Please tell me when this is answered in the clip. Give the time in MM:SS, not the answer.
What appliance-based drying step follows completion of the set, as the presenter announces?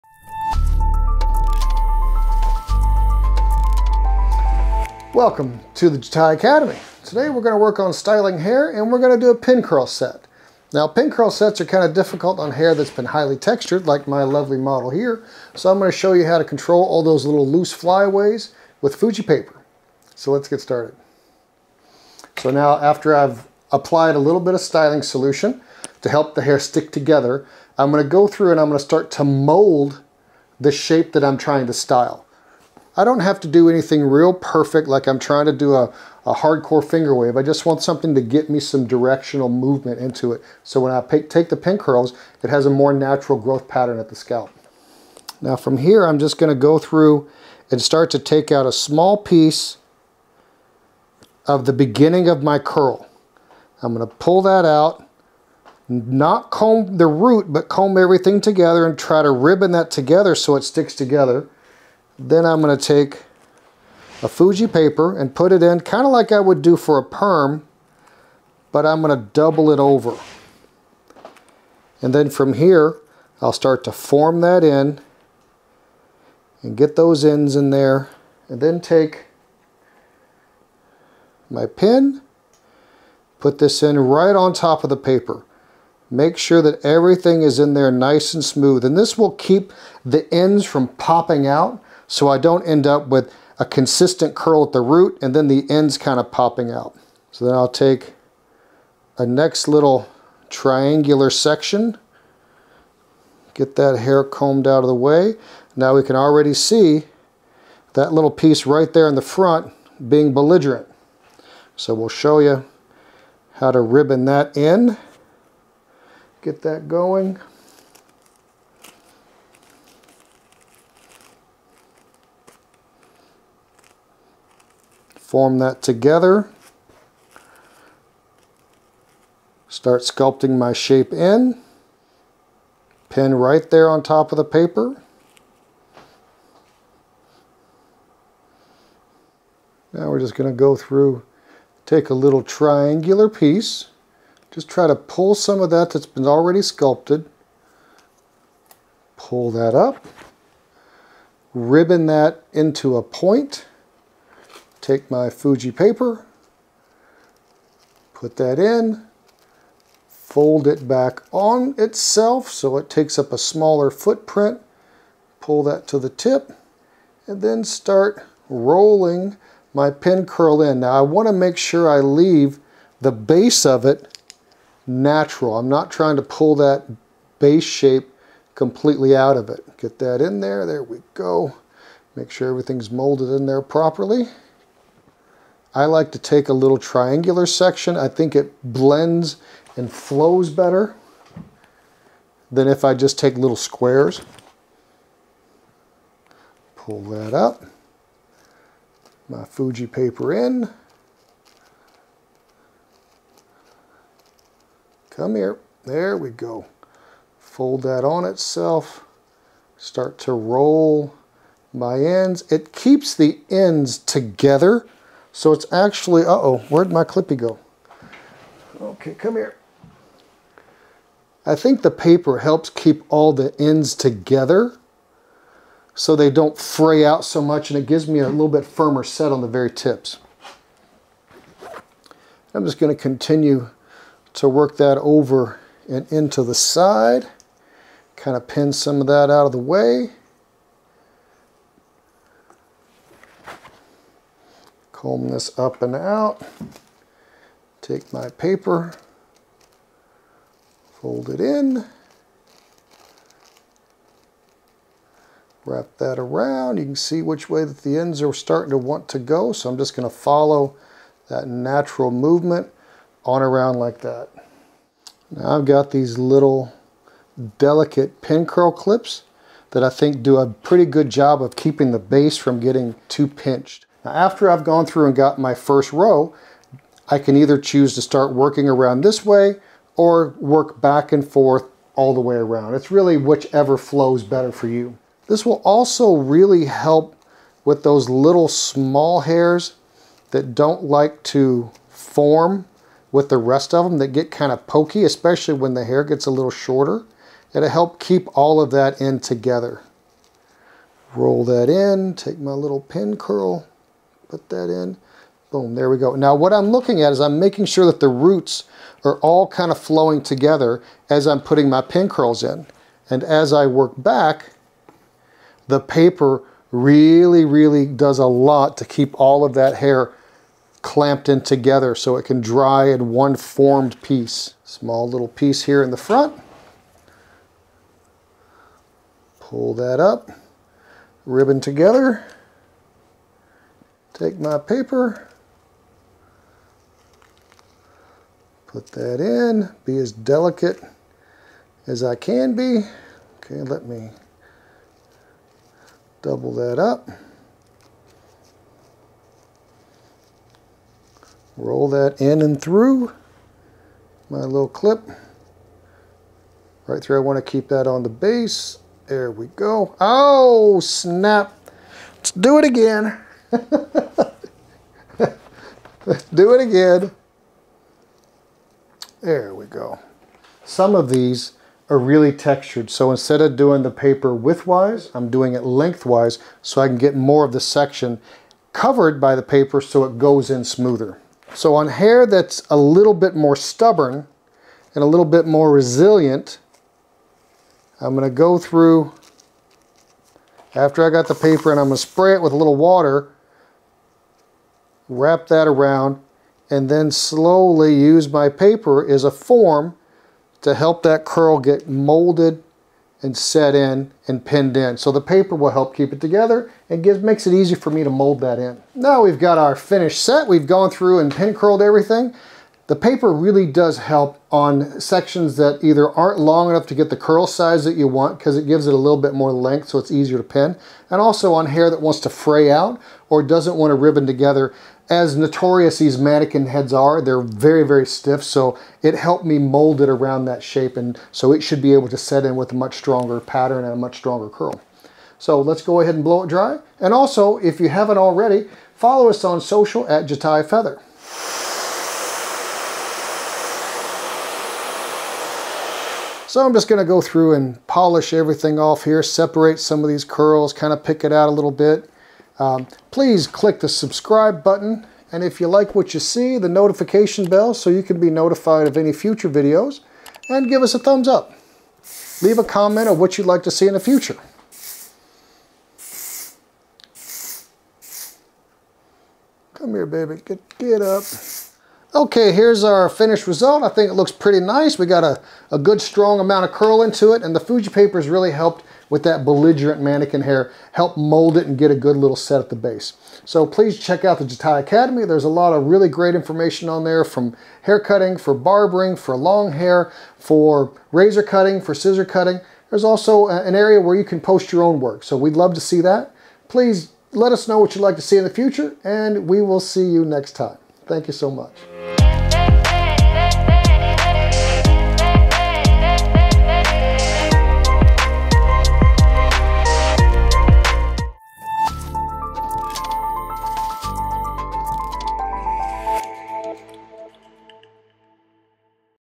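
07:16.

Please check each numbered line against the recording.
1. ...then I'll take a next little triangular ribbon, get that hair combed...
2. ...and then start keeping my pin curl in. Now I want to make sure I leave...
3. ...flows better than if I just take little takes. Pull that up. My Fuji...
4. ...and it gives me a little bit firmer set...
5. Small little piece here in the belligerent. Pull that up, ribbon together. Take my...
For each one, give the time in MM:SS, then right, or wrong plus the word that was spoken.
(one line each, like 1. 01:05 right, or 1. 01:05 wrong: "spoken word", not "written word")
1. 01:37 wrong: "section", not "ribbon"
2. 02:47 wrong: "rolling", not "keeping"
3. 03:09 wrong: "squares", not "takes"
4. 03:47 right
5. 05:24 wrong: "front", not "belligerent".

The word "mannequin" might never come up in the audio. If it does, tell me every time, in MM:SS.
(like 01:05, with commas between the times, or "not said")
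07:06, 08:00.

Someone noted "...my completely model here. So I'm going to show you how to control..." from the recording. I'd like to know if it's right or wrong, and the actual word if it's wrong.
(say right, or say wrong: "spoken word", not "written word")
wrong: "lovely", not "completely".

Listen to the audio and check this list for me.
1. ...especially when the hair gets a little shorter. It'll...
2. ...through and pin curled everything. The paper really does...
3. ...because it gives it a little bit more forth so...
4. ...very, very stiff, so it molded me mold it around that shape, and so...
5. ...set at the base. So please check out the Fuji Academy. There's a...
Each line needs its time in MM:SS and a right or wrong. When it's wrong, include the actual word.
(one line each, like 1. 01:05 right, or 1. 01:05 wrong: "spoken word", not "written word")
1. 04:55 right
2. 06:50 right
3. 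06:58 wrong: "length", not "forth"
4. 07:07 wrong: "helped", not "molded"
5. 08:02 wrong: "Jatai", not "Fuji".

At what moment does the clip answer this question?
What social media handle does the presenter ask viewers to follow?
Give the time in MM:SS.
07:20.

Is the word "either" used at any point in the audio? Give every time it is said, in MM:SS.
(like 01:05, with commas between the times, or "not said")
04:37, 06:55.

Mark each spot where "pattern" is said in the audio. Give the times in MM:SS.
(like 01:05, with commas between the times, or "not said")
00:43, 07:13.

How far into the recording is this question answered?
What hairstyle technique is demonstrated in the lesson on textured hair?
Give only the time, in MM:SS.
00:09.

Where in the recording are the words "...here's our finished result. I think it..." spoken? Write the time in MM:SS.
07:52.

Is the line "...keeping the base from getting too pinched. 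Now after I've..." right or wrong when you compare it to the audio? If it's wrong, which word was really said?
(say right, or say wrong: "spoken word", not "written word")
right.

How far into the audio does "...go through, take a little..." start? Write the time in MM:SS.
02:20.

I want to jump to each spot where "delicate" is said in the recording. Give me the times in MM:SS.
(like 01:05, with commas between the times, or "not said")
04:27, 05:40.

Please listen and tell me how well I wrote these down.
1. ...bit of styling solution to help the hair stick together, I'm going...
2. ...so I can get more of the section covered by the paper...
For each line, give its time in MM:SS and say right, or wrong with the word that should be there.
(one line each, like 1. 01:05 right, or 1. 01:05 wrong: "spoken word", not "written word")
1. 00:24 right
2. 06:16 right.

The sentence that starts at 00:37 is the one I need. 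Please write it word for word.
I just want something to get me some directional movement into it.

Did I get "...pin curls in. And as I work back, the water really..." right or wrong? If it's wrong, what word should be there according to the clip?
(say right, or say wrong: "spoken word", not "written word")
wrong: "paper", not "water".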